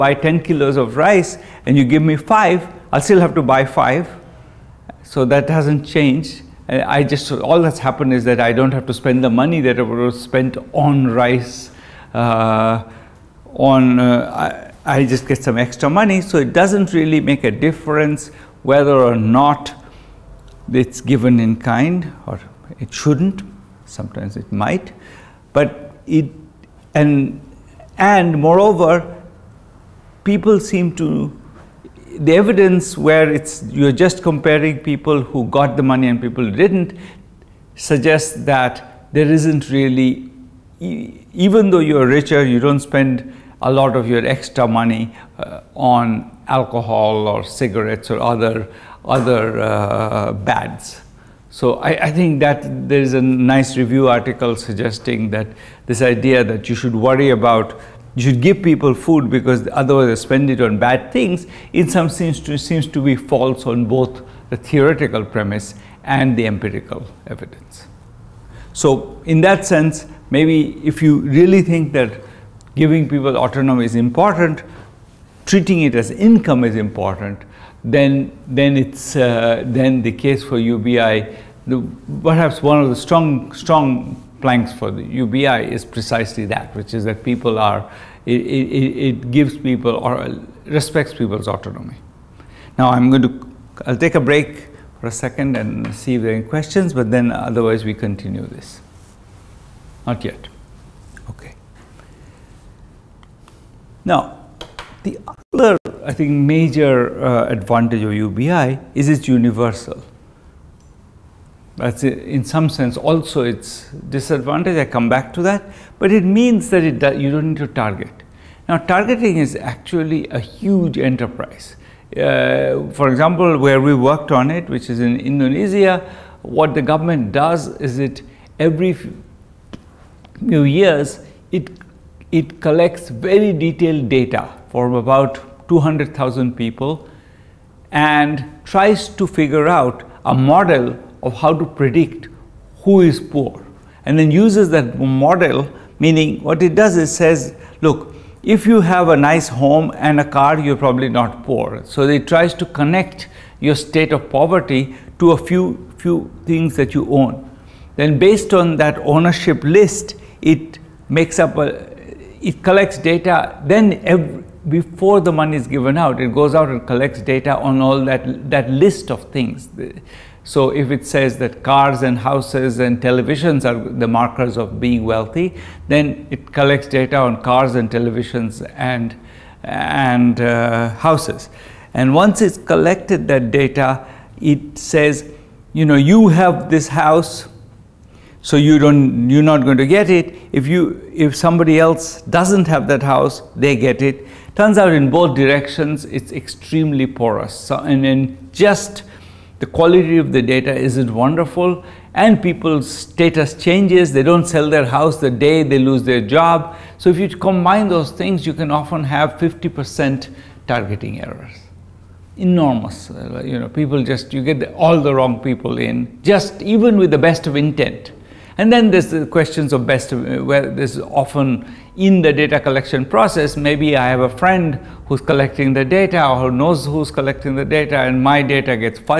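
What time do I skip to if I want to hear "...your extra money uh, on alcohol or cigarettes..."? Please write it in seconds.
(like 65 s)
44 s.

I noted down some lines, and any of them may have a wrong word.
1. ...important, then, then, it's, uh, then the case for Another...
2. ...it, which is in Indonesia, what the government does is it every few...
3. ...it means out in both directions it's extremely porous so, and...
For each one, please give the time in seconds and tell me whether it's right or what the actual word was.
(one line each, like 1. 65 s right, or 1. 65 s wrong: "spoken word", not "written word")
1. 76 s wrong: "UBI", not "Another"
2. 124 s right
3. 194 s wrong: "turns", not "means".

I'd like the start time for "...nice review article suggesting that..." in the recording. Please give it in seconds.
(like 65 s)
53 s.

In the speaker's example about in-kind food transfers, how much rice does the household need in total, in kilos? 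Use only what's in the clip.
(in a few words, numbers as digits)
10.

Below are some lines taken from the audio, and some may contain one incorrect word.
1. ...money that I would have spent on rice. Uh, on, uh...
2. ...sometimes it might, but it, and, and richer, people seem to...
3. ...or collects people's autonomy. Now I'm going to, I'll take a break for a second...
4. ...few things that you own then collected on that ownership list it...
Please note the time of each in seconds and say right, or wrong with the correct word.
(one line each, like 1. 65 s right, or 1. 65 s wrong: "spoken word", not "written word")
1. 9 s right
2. 23 s wrong: "moreover", not "richer"
3. 89 s wrong: "respects", not "collects"
4. 156 s wrong: "based", not "collected".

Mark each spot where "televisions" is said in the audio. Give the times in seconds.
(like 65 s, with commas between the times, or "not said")
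173 s, 177 s.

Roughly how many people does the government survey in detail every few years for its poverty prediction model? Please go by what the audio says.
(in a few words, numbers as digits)
200,000.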